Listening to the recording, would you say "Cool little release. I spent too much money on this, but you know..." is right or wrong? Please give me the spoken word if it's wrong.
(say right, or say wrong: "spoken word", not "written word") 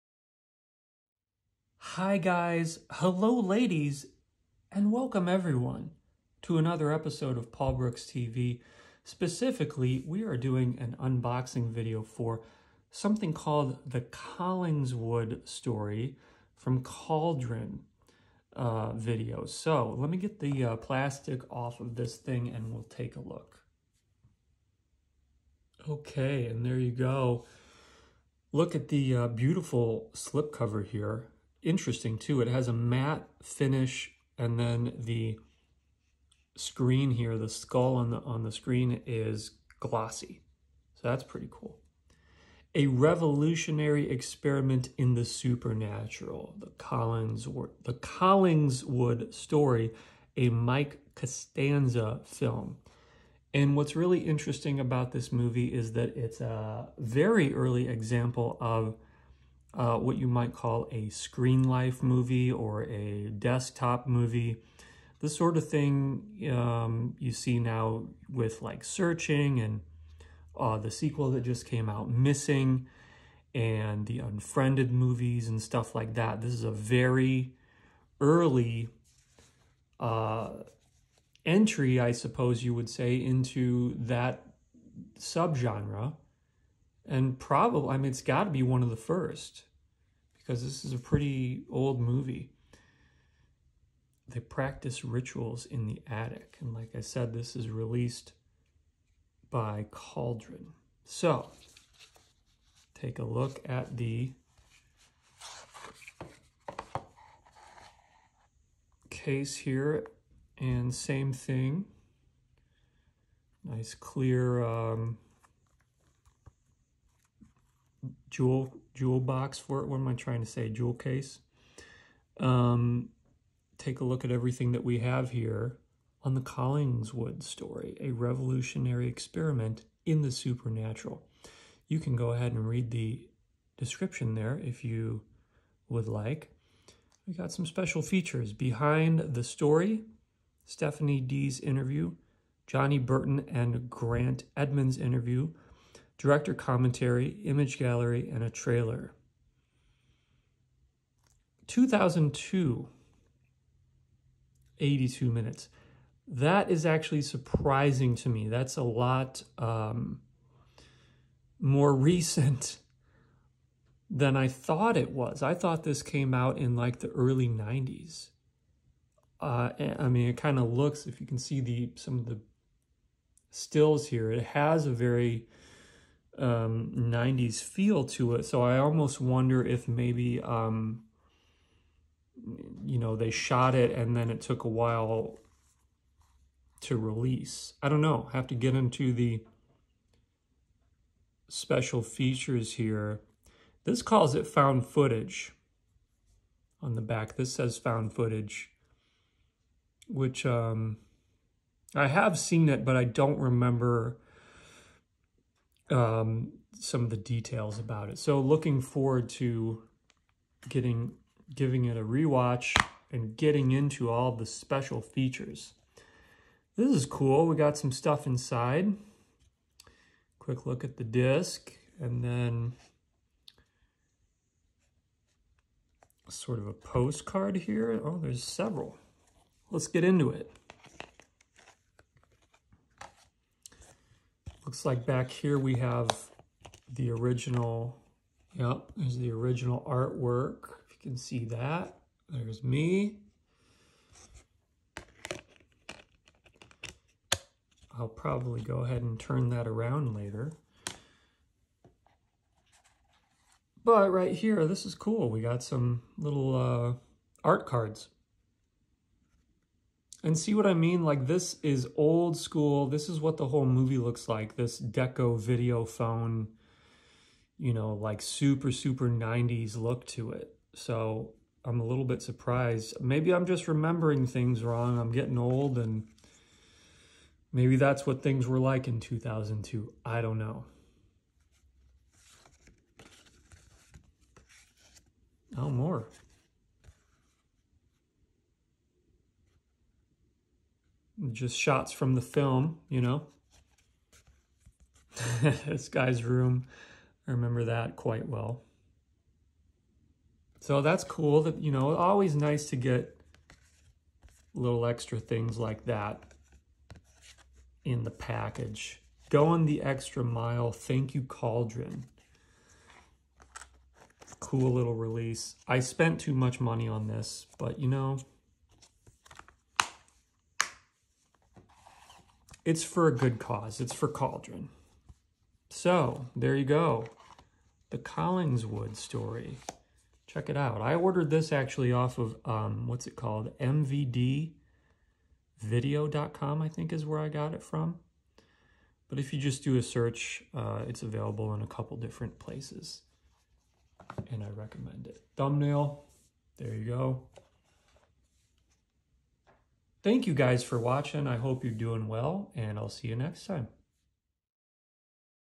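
right.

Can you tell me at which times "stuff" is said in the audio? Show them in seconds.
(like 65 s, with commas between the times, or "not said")
75 s, 217 s.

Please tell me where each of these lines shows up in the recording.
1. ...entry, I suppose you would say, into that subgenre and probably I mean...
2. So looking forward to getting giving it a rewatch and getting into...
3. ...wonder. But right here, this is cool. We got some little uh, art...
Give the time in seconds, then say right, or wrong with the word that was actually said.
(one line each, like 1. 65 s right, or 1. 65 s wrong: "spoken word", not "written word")
1. 81 s right
2. 208 s right
3. 250 s wrong: "later", not "wonder".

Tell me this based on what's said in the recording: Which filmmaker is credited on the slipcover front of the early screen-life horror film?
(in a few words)
Mike Costanza.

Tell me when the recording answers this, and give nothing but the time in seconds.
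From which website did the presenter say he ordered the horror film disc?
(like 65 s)
333 s.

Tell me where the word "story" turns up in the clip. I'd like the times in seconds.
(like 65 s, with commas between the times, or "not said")
15 s, 49 s, 127 s, 139 s, 328 s.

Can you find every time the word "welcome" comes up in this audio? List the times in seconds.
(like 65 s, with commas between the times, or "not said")
4 s.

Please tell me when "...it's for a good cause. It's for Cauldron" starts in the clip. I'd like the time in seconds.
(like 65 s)
322 s.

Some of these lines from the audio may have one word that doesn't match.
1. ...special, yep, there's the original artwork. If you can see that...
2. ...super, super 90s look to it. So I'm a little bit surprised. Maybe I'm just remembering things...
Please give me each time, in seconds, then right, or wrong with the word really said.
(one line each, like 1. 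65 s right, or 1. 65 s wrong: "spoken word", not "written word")
1. 237 s wrong: "original", not "special"
2. 268 s right.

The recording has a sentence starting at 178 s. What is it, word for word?
So I almost wonder if maybe, um, you know, they shot it and then it took a while to release.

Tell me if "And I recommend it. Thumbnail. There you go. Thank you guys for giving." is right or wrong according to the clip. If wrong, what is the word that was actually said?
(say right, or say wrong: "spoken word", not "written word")
wrong: "watching", not "giving".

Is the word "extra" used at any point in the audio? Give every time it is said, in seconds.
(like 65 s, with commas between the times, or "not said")
304 s, 309 s.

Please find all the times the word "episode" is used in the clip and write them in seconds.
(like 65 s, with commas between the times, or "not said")
6 s.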